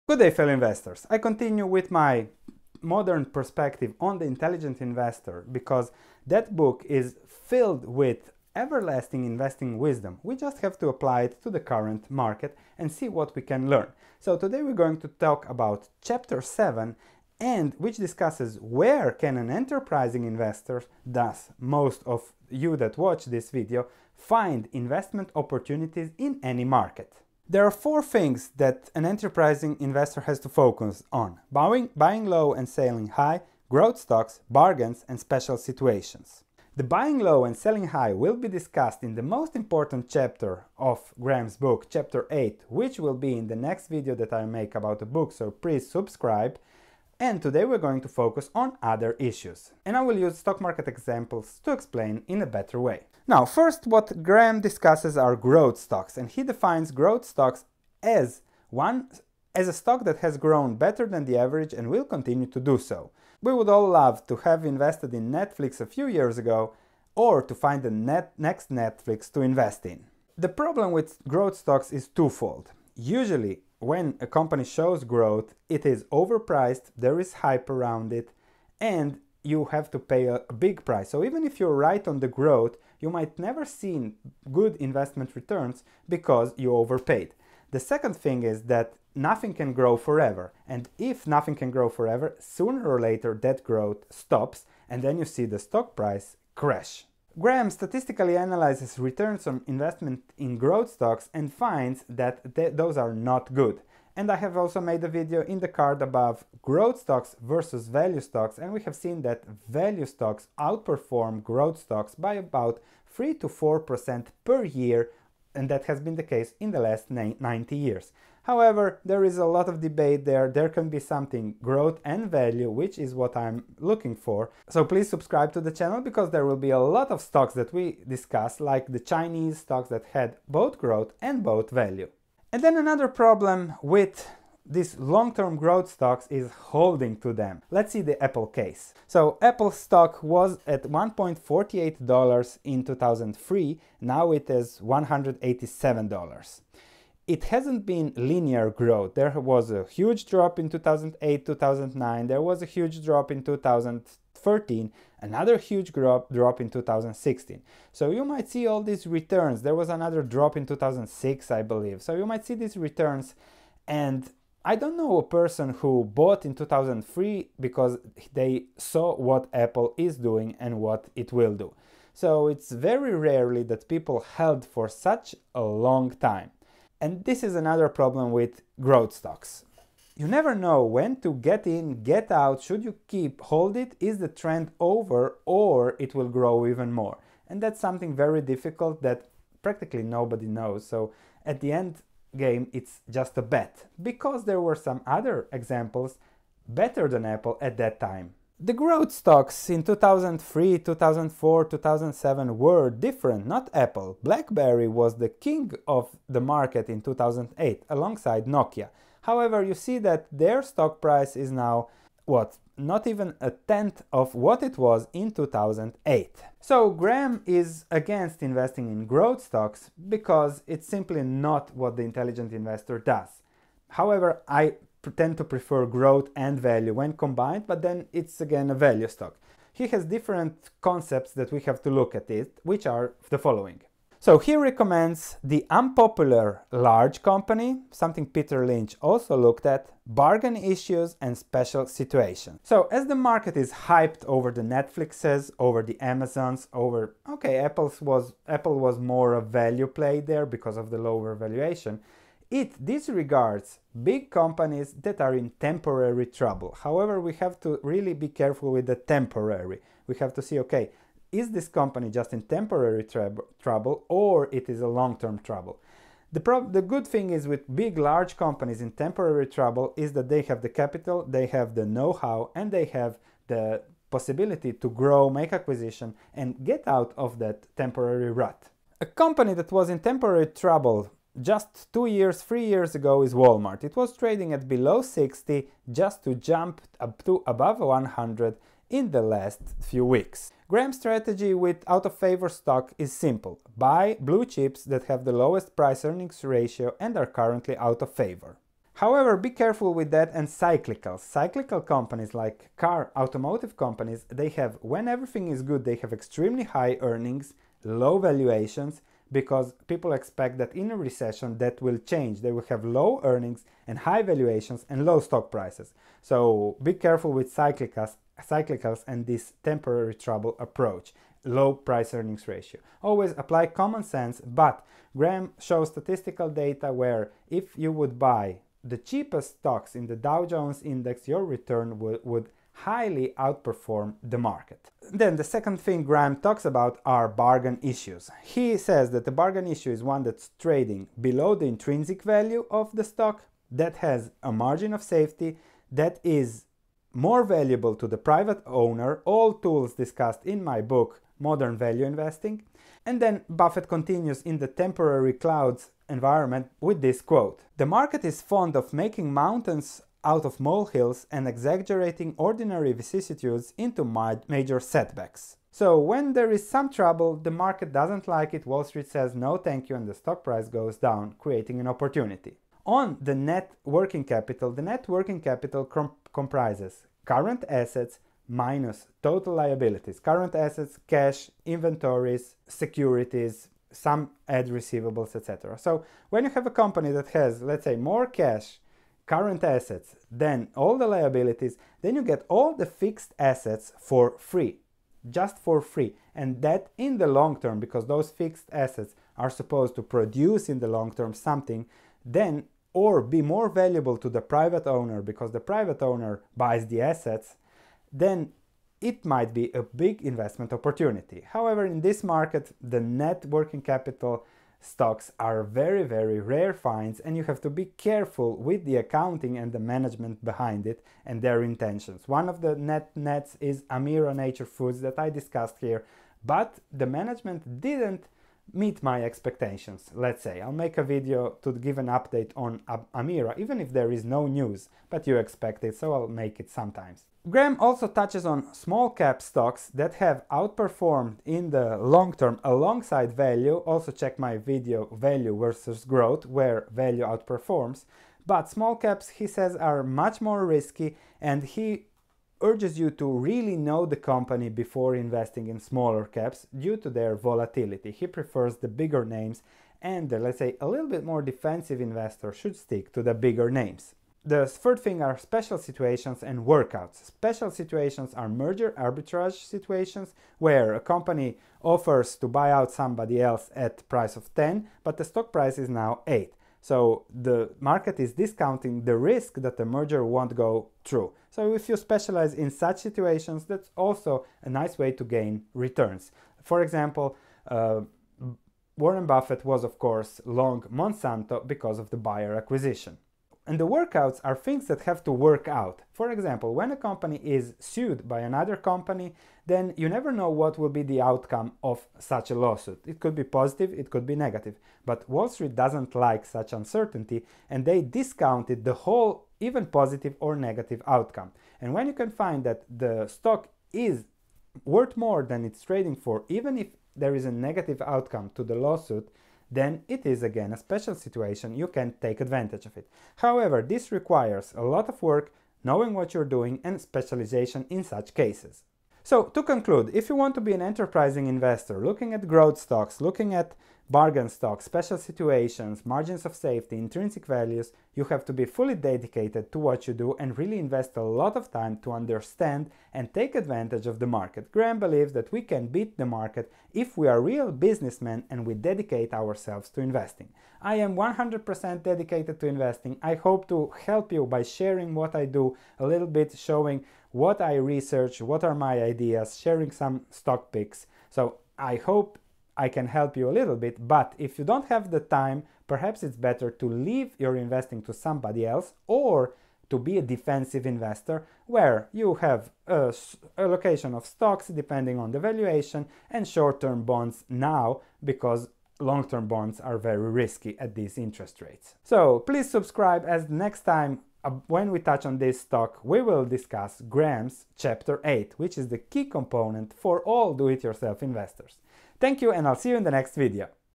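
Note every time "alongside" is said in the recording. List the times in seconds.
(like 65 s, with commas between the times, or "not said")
207 s, 442 s.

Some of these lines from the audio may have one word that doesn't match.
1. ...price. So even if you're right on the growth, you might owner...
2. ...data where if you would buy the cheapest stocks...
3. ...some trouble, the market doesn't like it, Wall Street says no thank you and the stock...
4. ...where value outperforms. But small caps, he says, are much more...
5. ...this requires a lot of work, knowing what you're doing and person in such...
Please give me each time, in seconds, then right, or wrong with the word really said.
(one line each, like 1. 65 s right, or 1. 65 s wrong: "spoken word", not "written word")
1. 80 s wrong: "never", not "owner"
2. 326 s right
3. 366 s right
4. 446 s right
5. 523 s wrong: "specialization", not "person".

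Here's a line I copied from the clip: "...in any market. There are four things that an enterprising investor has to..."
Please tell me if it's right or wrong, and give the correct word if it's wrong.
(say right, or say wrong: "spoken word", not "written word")
right.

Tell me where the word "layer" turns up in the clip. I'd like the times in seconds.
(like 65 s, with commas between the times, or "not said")
not said.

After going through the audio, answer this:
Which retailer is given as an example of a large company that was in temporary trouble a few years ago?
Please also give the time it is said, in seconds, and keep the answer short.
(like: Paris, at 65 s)
Walmart, at 283 s.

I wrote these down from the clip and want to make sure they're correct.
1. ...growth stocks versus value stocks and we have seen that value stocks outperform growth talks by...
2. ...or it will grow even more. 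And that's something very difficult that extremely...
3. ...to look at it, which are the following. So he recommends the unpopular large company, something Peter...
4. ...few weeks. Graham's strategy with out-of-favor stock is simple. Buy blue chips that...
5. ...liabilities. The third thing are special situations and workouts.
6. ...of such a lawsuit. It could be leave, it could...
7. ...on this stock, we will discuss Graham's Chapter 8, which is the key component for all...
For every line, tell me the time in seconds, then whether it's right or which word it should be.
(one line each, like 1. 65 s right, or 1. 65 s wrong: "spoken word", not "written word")
1. 106 s wrong: "stocks", not "talks"
2. 185 s wrong: "practically", not "extremely"
3. 231 s right
4. 289 s right
5. 463 s wrong: "names", not "liabilities"
6. 501 s wrong: "positive", not "leave"
7. 585 s right.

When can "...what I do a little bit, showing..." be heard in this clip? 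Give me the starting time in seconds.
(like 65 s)
555 s.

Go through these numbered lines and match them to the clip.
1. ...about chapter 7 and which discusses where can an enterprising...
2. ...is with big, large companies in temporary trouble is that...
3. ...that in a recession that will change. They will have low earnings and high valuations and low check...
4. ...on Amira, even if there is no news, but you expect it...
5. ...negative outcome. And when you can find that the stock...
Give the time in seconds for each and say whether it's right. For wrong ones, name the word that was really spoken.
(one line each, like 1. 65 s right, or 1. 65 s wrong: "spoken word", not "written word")
1. 15 s right
2. 267 s right
3. 310 s wrong: "stock", not "check"
4. 432 s right
5. 510 s right.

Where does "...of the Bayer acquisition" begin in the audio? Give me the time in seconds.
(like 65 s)
491 s.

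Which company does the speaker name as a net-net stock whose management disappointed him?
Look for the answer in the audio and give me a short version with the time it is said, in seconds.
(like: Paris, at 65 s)
Amira Nature Foods, at 423 s.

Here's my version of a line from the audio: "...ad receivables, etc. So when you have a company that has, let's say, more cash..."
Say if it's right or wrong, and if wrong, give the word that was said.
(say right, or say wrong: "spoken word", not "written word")
right.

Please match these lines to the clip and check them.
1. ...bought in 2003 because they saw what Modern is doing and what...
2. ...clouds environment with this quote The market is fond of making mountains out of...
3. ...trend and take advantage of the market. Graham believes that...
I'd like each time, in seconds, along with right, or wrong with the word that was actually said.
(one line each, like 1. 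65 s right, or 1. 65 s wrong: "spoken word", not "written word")
1. 166 s wrong: "Apple", not "Modern"
2. 355 s right
3. 542 s wrong: "understand", not "trend".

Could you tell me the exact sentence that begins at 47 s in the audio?
And today we're going to focus on other issues.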